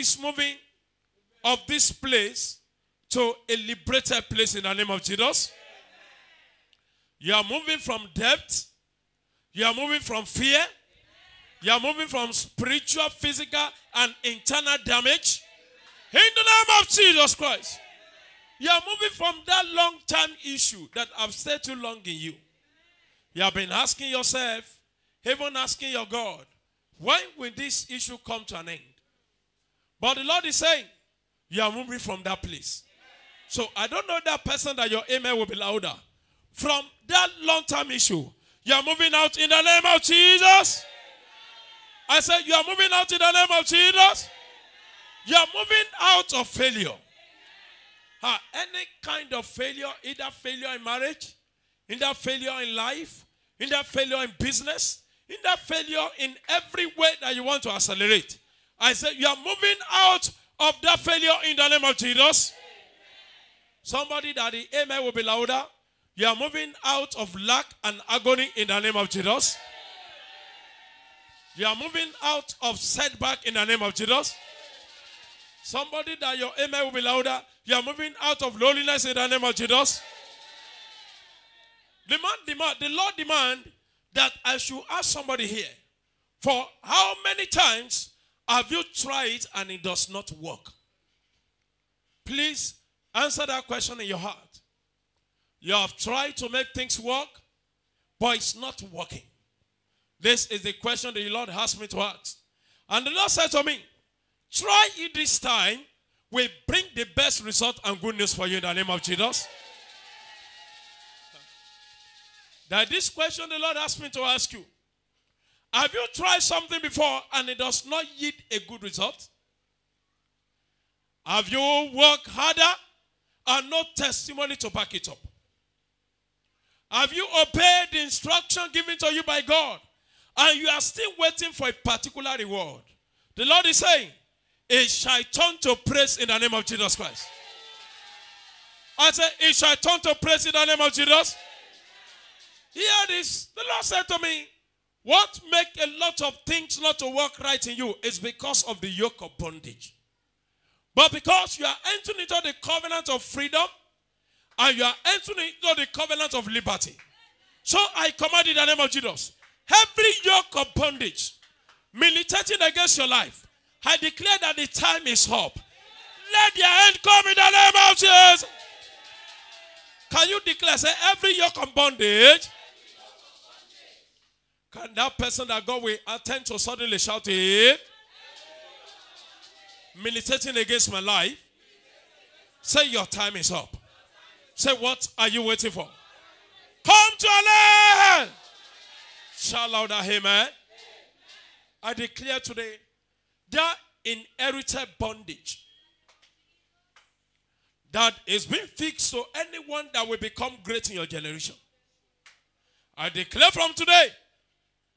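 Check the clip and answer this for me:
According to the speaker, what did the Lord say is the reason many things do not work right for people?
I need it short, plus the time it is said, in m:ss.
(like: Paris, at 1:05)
The yoke of bondage, at 2:28.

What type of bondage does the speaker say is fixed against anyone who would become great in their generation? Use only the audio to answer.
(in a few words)
Inherited bondage.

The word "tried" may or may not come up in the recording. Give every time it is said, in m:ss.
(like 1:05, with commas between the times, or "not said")
1:28, 1:35, 1:56.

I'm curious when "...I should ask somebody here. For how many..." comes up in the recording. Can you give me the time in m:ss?
1:24.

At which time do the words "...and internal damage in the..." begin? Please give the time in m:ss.
0:13.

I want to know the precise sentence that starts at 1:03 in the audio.
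Somebody that the amen will be louder.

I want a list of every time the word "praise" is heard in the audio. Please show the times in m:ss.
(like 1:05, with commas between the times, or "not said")
2:15, 2:20.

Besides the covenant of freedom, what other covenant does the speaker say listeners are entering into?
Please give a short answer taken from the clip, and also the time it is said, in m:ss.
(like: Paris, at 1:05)
Covenant of liberty, at 2:35.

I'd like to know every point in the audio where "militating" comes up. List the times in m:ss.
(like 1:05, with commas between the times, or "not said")
2:41, 3:00.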